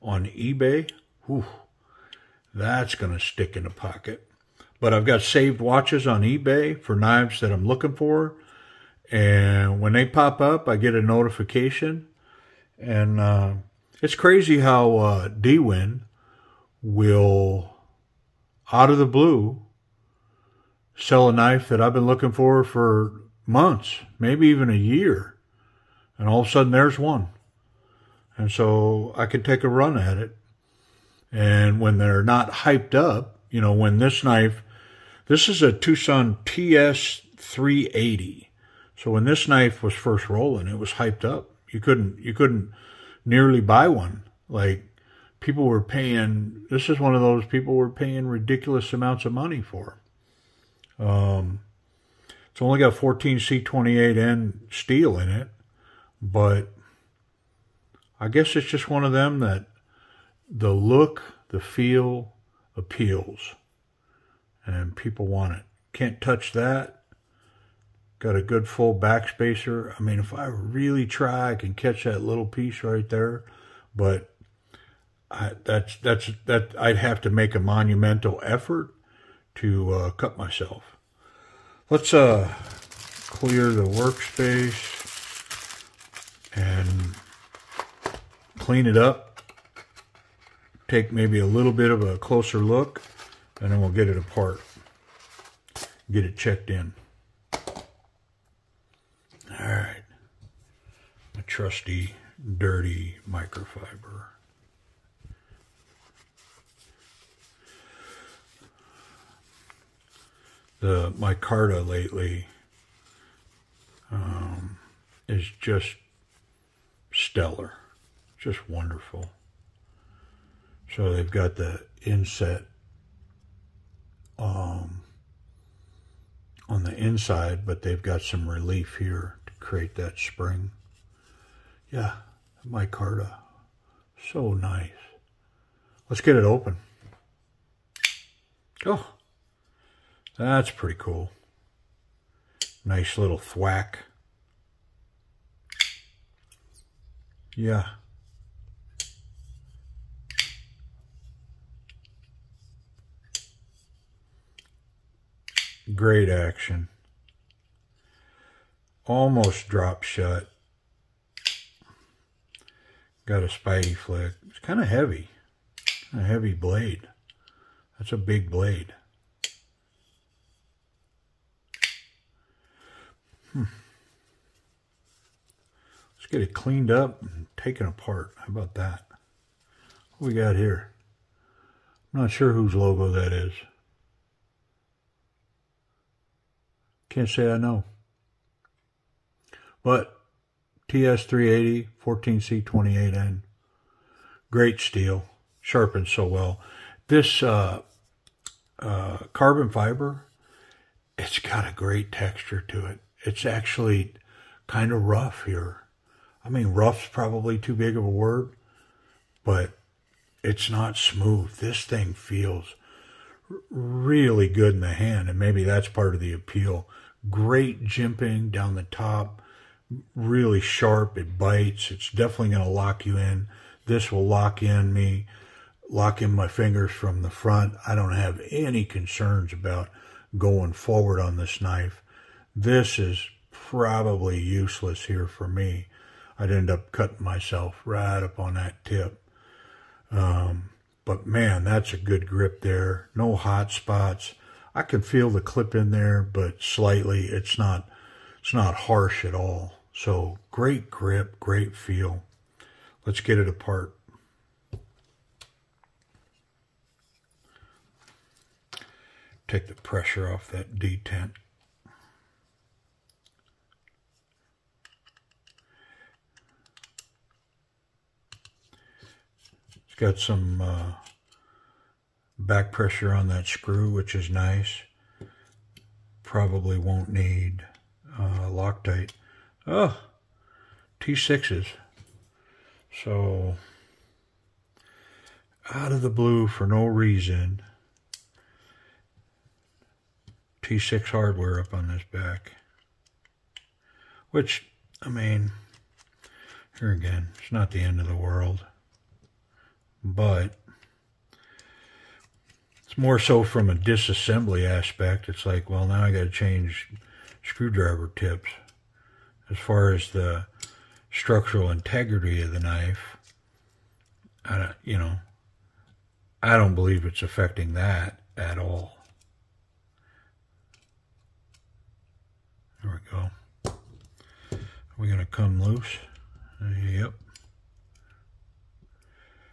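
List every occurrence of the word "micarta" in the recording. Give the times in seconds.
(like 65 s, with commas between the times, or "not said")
111 s, 132 s.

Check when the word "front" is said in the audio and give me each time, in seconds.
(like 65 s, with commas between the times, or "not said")
227 s.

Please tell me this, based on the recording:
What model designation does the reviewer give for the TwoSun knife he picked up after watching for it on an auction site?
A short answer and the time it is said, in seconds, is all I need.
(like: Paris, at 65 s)
TS 380, at 35 s.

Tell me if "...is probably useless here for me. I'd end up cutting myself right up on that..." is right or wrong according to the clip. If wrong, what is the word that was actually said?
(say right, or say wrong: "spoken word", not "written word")
right.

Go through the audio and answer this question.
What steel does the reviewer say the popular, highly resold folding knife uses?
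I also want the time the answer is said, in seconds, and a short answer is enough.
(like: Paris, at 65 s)
14C28N, at 52 s.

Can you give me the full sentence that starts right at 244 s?
I can feel the clip in there, but slightly.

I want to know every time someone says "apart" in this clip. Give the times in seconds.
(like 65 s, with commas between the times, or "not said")
94 s, 177 s, 253 s.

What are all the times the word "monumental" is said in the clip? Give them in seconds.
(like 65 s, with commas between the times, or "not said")
77 s.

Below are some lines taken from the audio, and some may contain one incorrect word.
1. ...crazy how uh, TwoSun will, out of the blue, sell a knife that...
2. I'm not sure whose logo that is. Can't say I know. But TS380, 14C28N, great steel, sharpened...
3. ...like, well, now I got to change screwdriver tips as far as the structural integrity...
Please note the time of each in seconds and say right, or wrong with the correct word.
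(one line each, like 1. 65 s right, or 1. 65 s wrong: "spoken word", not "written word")
1. 14 s wrong: "Dwin", not "TwoSun"
2. 182 s right
3. 305 s right.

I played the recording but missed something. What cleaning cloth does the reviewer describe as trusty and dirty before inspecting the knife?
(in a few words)
Microfiber.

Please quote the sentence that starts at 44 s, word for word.
Like people were paying, this is one of those people were paying ridiculous amounts of money for.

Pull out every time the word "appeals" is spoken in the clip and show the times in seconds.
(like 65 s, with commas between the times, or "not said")
62 s, 216 s.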